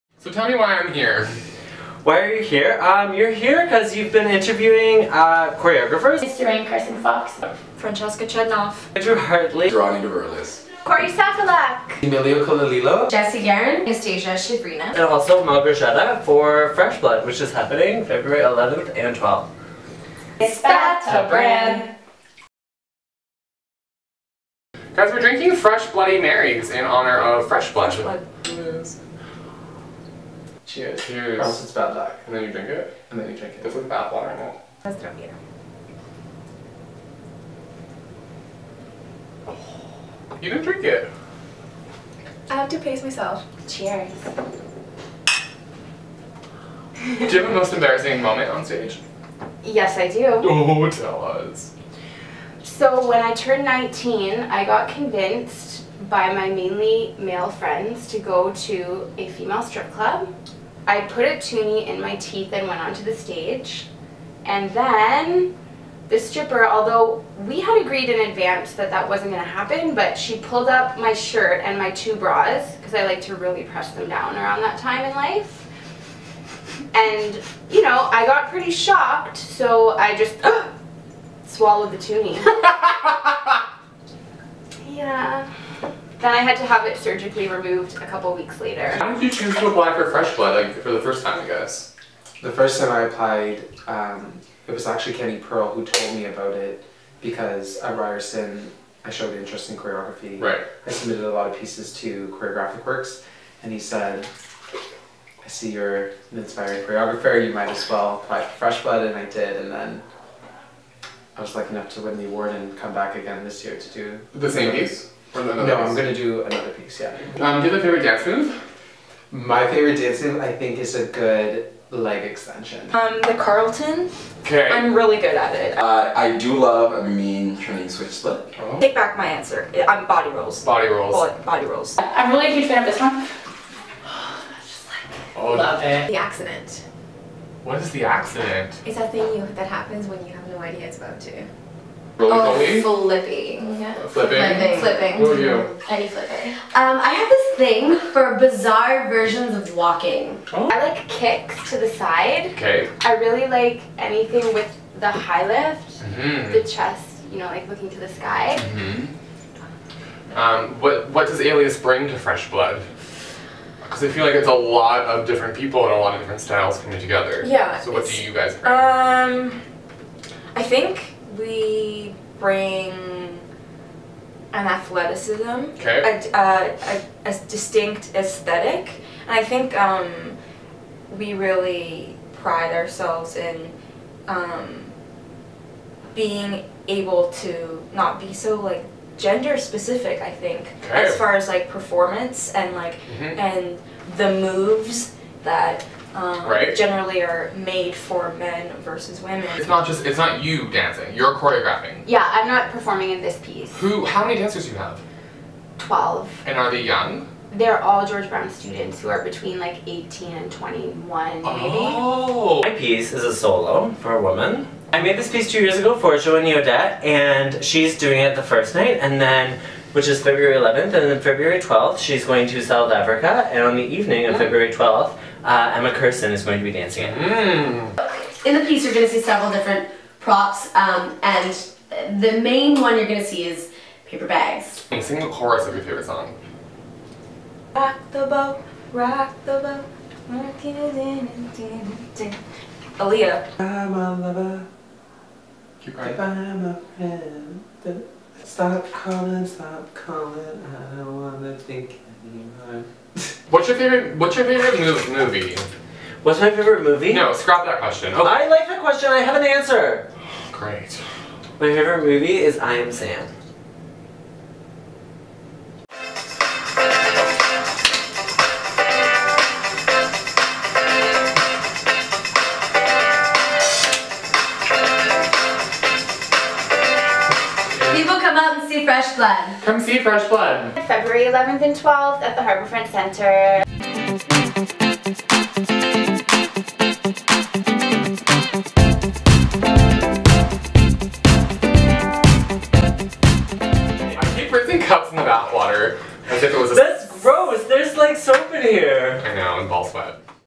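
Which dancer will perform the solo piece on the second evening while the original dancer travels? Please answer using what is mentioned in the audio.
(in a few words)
Emma Kirsten.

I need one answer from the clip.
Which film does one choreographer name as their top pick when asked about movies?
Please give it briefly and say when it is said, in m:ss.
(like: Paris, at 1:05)
I Am Sam, at 4:21.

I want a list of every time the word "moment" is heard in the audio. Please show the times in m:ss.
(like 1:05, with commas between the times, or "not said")
0:48.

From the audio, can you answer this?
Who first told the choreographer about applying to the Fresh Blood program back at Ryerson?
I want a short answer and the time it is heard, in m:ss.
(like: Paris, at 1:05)
Kenny Pearl, at 1:34.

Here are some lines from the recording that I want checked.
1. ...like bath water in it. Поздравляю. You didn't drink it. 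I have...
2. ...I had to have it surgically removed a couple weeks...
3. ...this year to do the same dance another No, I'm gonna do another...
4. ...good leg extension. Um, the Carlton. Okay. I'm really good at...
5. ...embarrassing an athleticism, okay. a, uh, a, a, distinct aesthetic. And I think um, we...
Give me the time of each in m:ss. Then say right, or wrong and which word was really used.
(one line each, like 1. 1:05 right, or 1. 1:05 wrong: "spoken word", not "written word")
1. 0:33 right
2. 1:26 right
3. 1:53 wrong: "piece", not "dance"
4. 2:01 right
5. 2:52 wrong: "bring", not "embarrassing".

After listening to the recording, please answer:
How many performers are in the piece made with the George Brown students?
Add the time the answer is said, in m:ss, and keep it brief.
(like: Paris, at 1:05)
12, at 3:25.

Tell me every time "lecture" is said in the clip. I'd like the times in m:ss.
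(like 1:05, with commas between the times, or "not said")
not said.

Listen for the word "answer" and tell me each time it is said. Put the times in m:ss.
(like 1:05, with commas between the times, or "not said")
2:09, 4:19.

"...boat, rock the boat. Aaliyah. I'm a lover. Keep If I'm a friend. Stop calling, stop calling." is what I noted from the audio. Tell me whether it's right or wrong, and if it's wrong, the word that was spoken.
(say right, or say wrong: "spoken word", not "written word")
right.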